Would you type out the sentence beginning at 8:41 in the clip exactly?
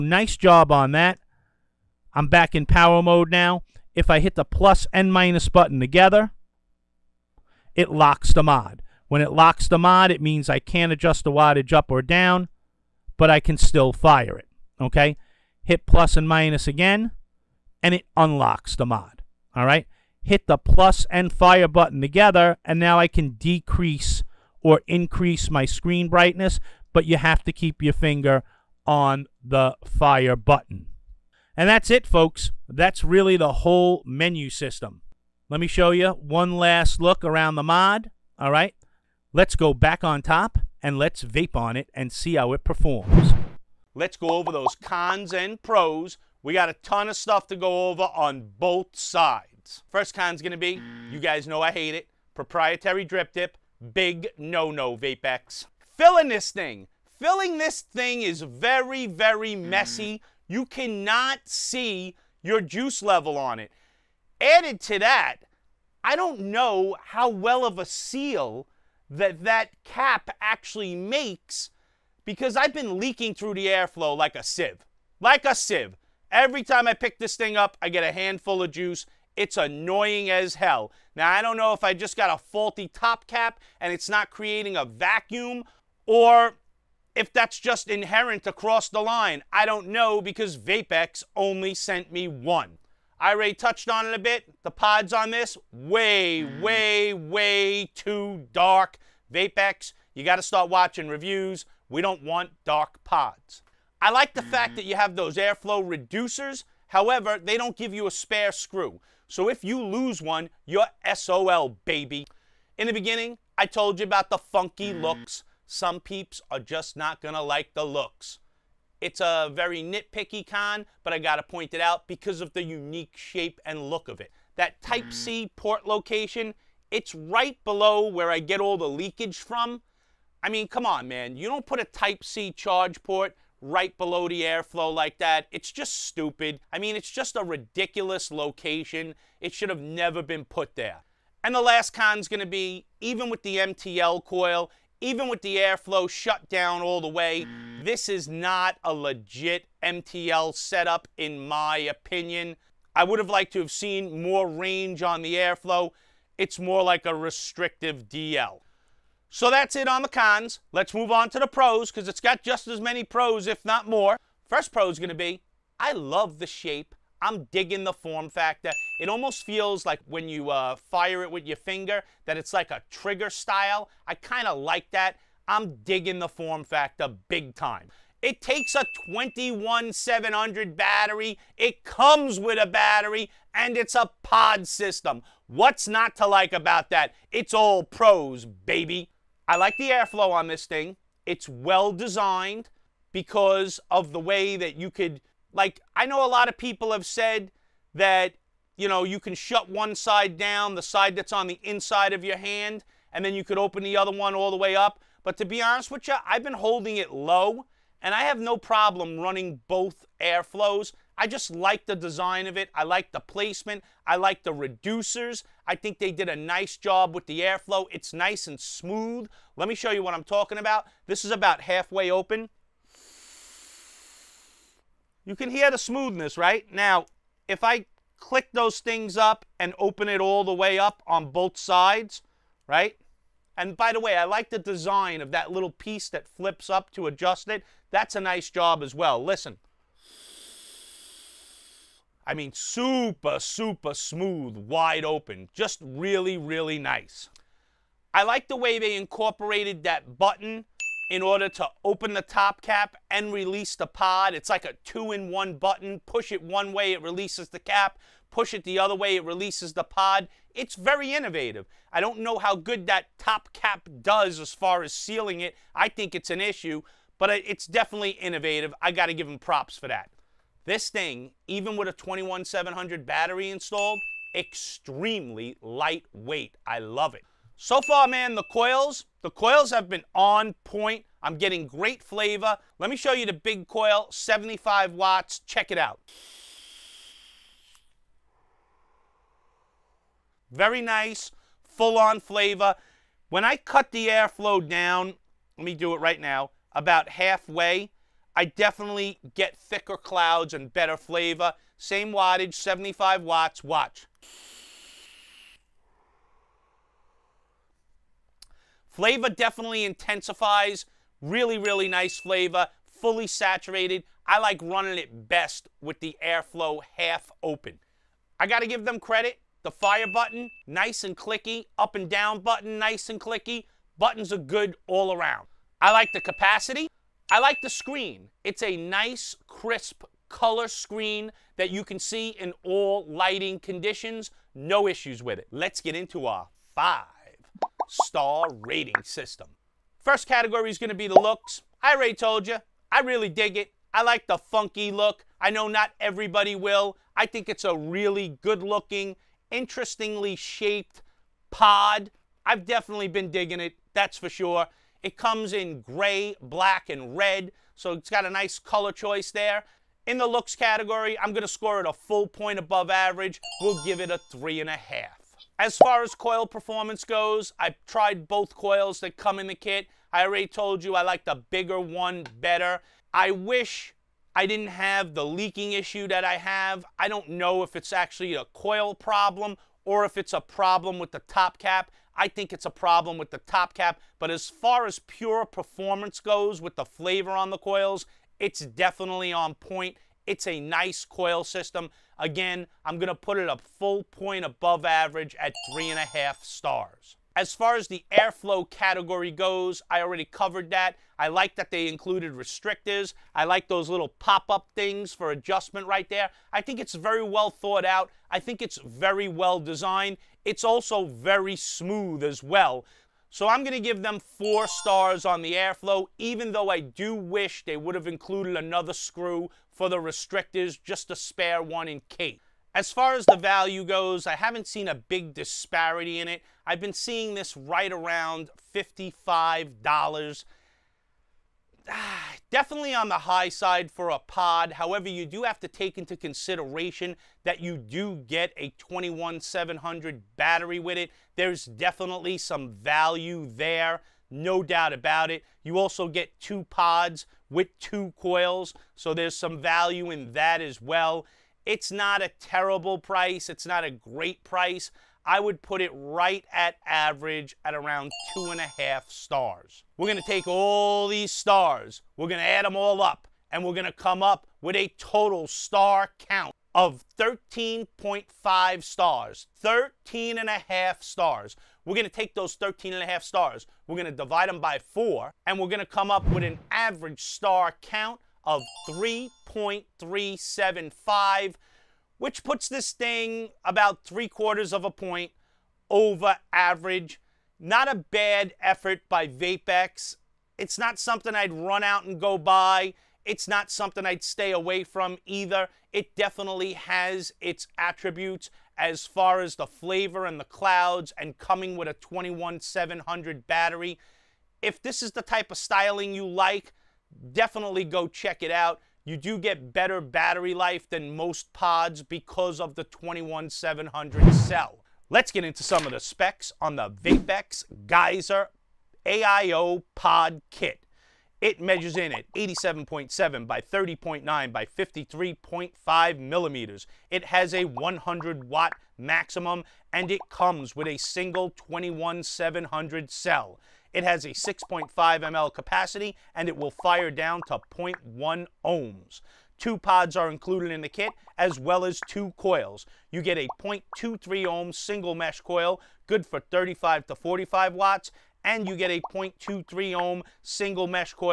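It measures in at 87.7 by 30.9 by 53.5 millimeters.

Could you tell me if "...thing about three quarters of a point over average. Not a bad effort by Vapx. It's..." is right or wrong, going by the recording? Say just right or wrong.
right.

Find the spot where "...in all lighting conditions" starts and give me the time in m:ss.
5:32.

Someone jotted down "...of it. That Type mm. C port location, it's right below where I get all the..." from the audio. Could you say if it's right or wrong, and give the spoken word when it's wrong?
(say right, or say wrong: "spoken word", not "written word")
right.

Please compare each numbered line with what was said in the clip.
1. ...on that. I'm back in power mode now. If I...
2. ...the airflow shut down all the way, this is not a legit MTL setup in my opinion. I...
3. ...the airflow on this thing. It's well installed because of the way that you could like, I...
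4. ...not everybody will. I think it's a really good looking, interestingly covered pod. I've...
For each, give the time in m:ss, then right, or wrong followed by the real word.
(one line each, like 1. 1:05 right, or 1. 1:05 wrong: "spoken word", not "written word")
1. 0:00 right
2. 2:25 right
3. 3:09 wrong: "designed", not "installed"
4. 5:45 wrong: "shaped", not "covered".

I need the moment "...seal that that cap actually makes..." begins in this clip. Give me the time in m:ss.
1:07.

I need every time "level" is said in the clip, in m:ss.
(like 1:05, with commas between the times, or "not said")
1:03.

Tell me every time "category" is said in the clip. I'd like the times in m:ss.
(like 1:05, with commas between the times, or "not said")
5:40, 6:00, 6:38.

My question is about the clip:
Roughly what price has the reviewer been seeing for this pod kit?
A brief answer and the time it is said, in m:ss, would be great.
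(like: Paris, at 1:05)
$55, at 7:08.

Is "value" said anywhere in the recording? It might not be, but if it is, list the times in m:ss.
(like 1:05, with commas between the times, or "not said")
7:03, 7:22, 7:29.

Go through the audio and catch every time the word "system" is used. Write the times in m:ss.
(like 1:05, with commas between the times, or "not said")
0:34, 3:04, 5:39, 6:31.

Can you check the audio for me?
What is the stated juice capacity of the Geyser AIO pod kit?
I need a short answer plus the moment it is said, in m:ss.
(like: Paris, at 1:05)
6.5 ml, at 8:54.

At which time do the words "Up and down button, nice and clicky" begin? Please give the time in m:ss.
5:21.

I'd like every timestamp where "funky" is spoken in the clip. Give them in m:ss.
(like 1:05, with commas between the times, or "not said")
1:54, 5:44.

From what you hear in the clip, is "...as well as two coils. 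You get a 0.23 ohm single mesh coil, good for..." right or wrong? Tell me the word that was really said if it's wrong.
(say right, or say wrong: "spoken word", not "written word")
right.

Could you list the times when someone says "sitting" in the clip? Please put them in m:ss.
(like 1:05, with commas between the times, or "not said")
not said.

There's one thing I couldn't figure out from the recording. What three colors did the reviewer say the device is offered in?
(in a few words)
gray, black, and red.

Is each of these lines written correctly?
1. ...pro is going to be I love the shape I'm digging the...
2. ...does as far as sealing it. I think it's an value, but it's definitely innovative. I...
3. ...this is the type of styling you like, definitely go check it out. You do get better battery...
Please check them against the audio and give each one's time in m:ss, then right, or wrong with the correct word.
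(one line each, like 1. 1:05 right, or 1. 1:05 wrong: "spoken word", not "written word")
1. 2:44 right
2. 4:24 wrong: "issue", not "value"
3. 8:24 right.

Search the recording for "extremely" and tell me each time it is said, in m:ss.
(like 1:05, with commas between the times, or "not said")
4:34.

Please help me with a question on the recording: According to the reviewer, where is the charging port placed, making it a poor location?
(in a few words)
right below the airflow.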